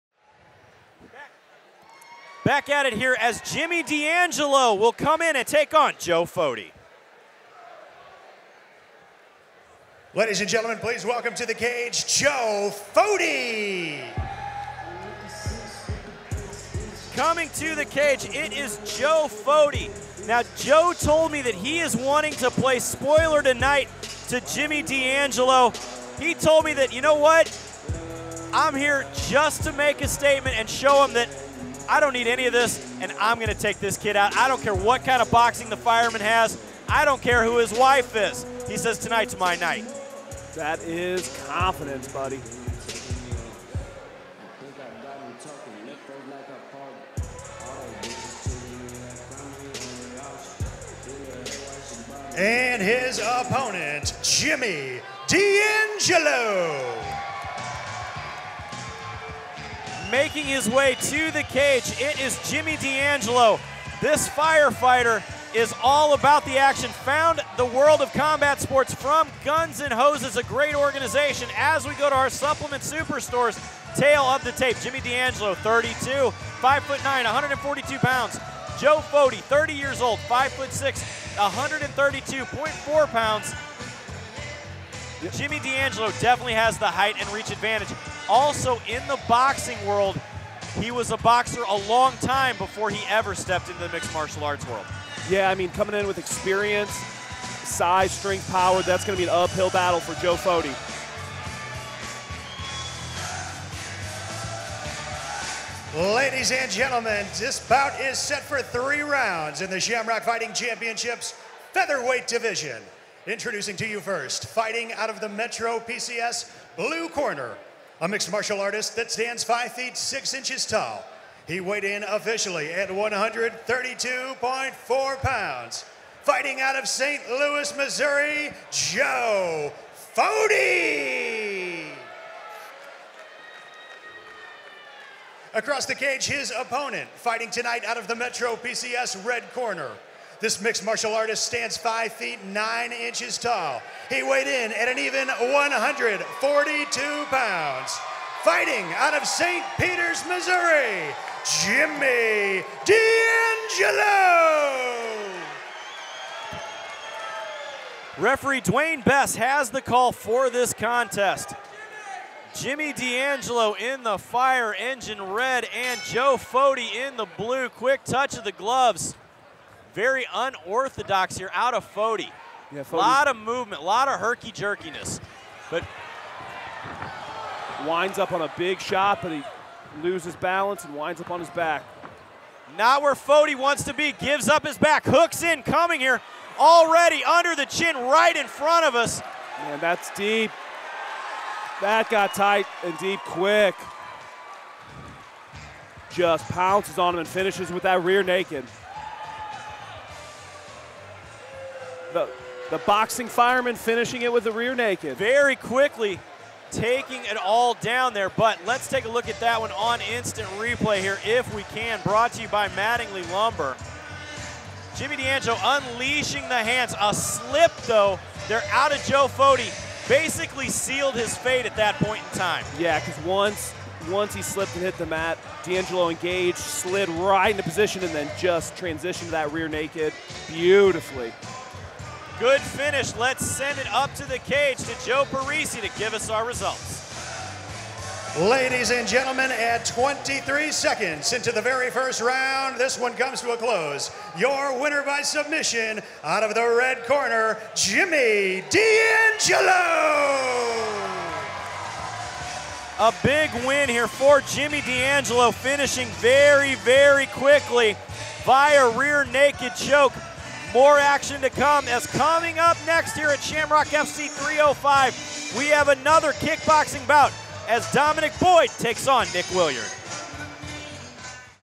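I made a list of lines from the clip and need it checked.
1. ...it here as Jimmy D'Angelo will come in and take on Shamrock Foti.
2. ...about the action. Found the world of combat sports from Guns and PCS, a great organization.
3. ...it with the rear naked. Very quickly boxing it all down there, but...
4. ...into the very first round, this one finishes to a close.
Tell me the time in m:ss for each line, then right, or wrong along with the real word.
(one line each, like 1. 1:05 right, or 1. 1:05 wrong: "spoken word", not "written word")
1. 0:02 wrong: "Joe", not "Shamrock"
2. 1:06 wrong: "Hoses", not "PCS"
3. 3:24 wrong: "taking", not "boxing"
4. 4:01 wrong: "comes", not "finishes".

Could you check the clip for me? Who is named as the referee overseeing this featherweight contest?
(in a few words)
Dwayne Bess.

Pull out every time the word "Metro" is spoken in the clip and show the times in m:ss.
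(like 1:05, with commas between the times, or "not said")
1:55, 2:18.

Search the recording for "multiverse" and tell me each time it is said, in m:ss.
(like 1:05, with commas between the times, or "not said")
not said.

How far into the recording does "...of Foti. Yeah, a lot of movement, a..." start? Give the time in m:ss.
2:51.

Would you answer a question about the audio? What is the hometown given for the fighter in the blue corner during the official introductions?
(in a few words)
St. Louis, Missouri.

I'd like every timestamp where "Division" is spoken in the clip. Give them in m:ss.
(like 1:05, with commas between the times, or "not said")
1:52.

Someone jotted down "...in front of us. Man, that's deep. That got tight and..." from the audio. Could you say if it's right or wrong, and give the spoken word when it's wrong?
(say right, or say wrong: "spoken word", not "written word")
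right.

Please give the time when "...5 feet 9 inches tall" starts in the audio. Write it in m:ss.
2:21.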